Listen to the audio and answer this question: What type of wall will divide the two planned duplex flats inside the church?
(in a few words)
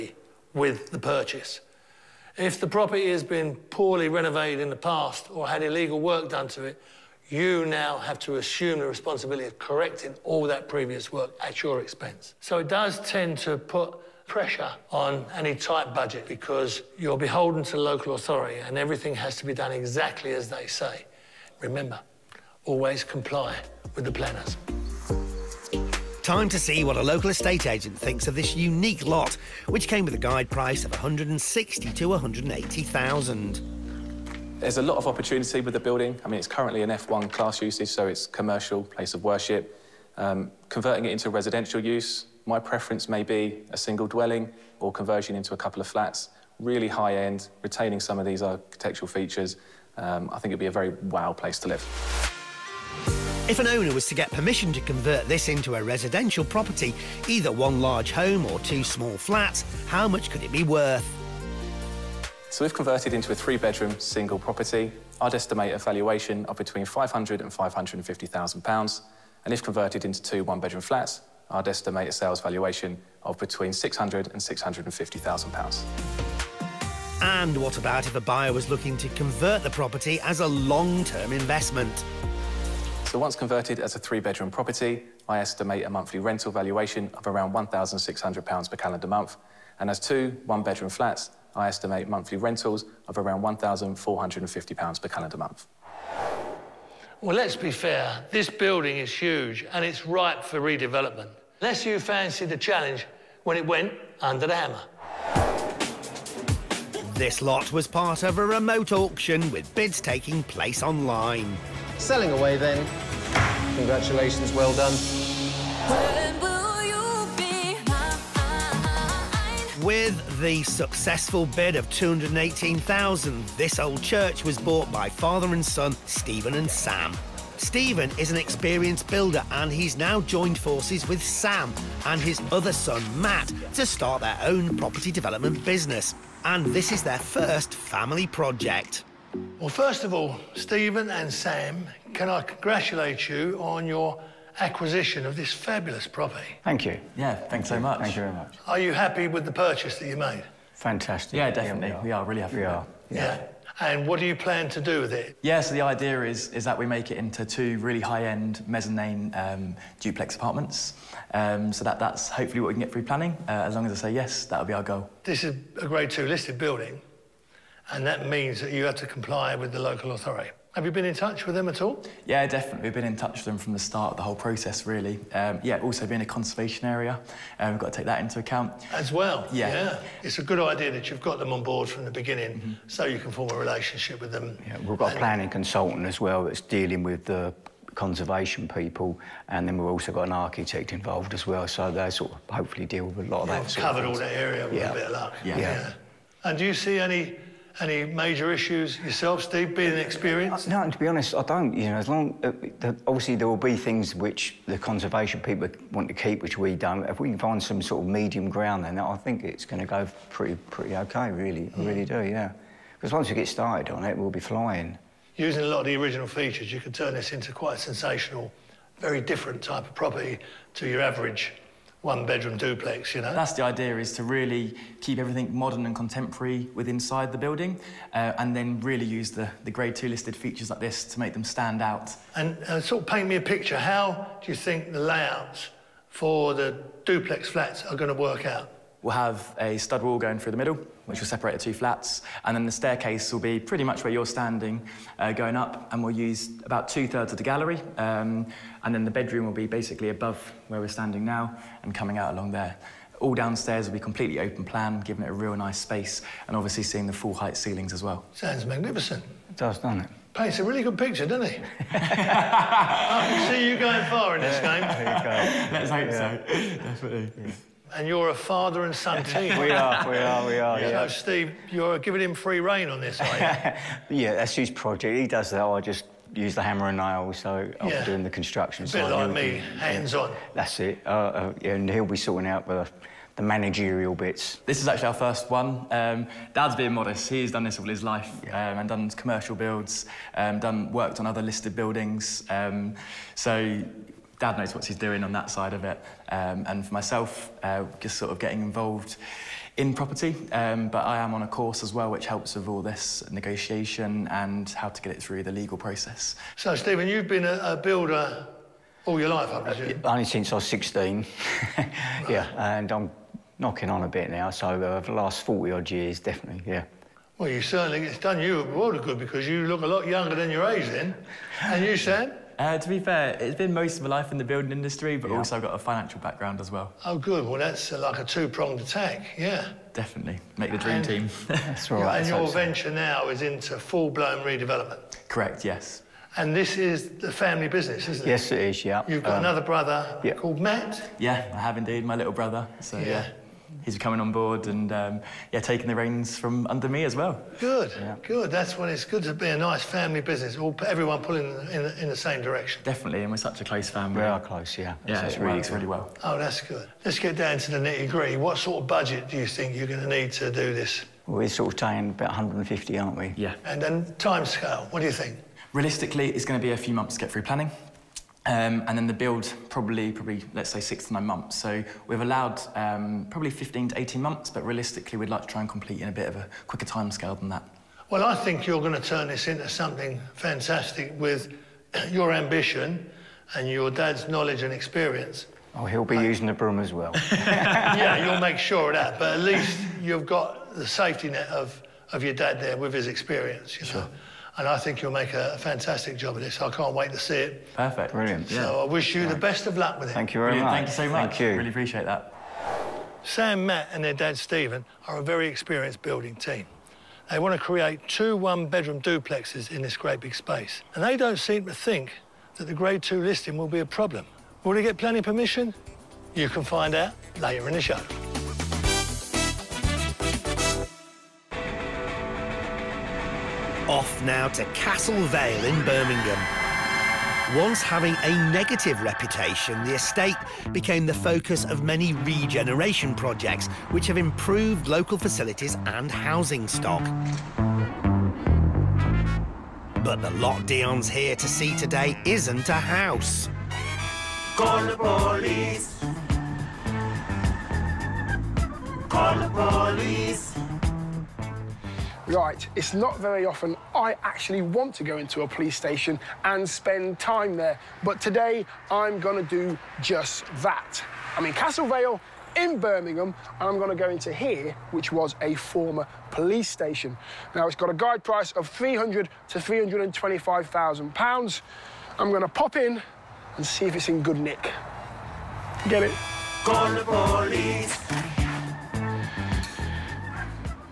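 stud wall.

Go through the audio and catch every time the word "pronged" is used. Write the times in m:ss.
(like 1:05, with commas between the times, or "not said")
5:28.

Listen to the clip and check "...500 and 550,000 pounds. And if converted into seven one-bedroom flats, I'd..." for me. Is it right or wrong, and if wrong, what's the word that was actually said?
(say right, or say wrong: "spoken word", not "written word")
wrong: "two", not "seven".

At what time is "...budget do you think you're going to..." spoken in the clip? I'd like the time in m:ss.
5:58.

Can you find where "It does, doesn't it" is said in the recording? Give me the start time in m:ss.
4:19.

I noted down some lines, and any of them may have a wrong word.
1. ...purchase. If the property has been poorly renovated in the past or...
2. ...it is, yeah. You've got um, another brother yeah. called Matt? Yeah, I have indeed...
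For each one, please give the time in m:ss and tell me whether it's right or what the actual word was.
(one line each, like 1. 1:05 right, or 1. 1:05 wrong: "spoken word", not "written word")
1. 0:00 right
2. 5:38 right.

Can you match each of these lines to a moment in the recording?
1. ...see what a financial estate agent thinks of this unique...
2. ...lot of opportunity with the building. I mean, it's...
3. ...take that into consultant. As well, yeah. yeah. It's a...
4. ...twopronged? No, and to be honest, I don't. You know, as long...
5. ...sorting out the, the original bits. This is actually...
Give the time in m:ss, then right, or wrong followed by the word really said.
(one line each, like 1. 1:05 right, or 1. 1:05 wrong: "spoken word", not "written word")
1. 0:26 wrong: "local", not "financial"
2. 0:34 right
3. 2:57 wrong: "account", not "consultant"
4. 3:19 wrong: "experienced", not "twopronged"
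5. 4:42 wrong: "managerial", not "original".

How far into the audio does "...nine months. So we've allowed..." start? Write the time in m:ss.
6:11.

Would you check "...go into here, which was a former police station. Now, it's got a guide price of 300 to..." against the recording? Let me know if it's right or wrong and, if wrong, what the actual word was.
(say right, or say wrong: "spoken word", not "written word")
right.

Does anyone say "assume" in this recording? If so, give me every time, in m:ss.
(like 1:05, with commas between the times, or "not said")
0:08.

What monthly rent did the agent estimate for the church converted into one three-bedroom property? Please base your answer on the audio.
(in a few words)
£1,600.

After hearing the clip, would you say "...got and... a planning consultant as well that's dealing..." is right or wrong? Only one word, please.
right.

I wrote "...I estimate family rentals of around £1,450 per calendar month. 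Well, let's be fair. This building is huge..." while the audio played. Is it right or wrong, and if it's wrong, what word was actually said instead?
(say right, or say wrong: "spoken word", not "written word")
wrong: "monthly", not "family".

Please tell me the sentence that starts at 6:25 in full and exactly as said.
Oh, he'll be using the broom as well.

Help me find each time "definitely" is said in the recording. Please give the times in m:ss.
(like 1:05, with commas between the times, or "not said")
2:31, 2:52, 4:26, 5:16, 5:29, 5:52.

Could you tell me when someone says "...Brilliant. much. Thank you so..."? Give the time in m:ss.
6:40.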